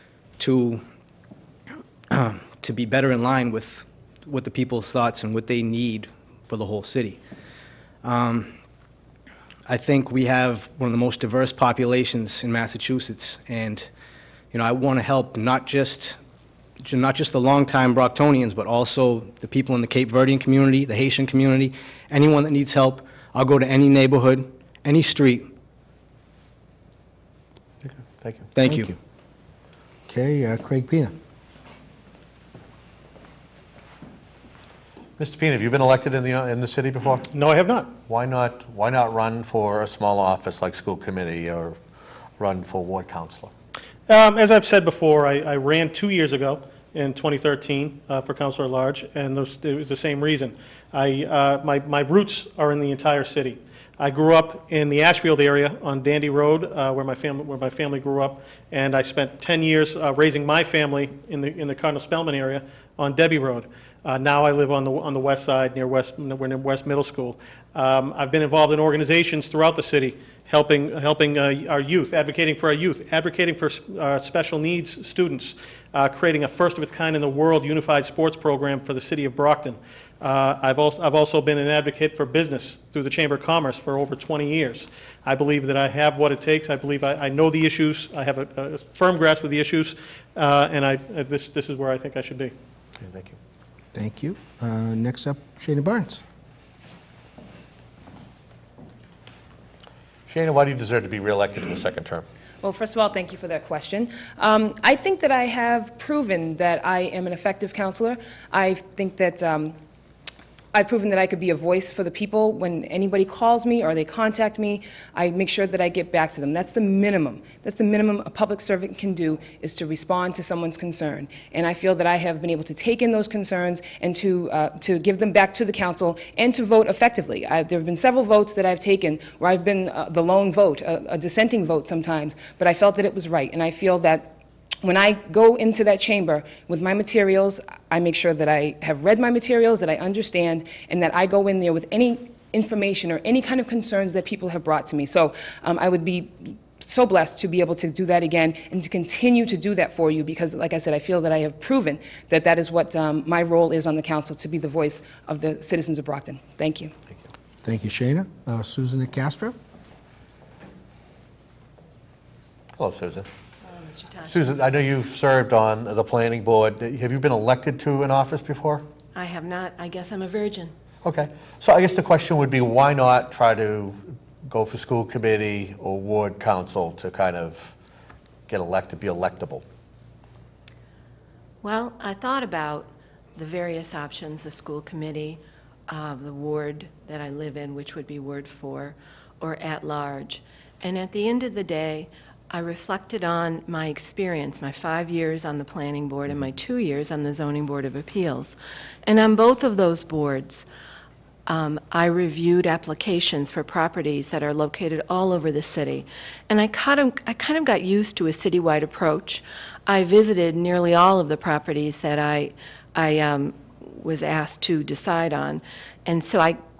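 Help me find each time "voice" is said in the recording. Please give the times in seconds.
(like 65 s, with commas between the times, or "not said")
111 s, 154 s.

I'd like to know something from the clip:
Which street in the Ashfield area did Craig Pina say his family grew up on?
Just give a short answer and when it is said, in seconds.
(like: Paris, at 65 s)
Dandy Road, at 56 s.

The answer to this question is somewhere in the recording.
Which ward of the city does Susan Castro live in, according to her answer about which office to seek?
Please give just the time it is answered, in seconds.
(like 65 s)
188 s.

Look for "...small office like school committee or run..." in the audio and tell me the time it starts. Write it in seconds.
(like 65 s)
39 s.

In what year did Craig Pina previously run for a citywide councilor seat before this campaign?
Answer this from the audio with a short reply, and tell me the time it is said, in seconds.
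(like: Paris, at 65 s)
2013, at 47 s.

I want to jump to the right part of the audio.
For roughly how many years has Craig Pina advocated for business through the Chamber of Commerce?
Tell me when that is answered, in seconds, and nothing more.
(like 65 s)
83 s.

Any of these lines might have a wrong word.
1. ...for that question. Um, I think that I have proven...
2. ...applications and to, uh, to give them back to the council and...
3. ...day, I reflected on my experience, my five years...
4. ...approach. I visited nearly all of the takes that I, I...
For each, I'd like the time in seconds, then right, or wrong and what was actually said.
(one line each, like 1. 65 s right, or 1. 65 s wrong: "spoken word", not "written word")
1. 103 s right
2. 123 s wrong: "concerns", not "applications"
3. 191 s right
4. 208 s wrong: "properties", not "takes".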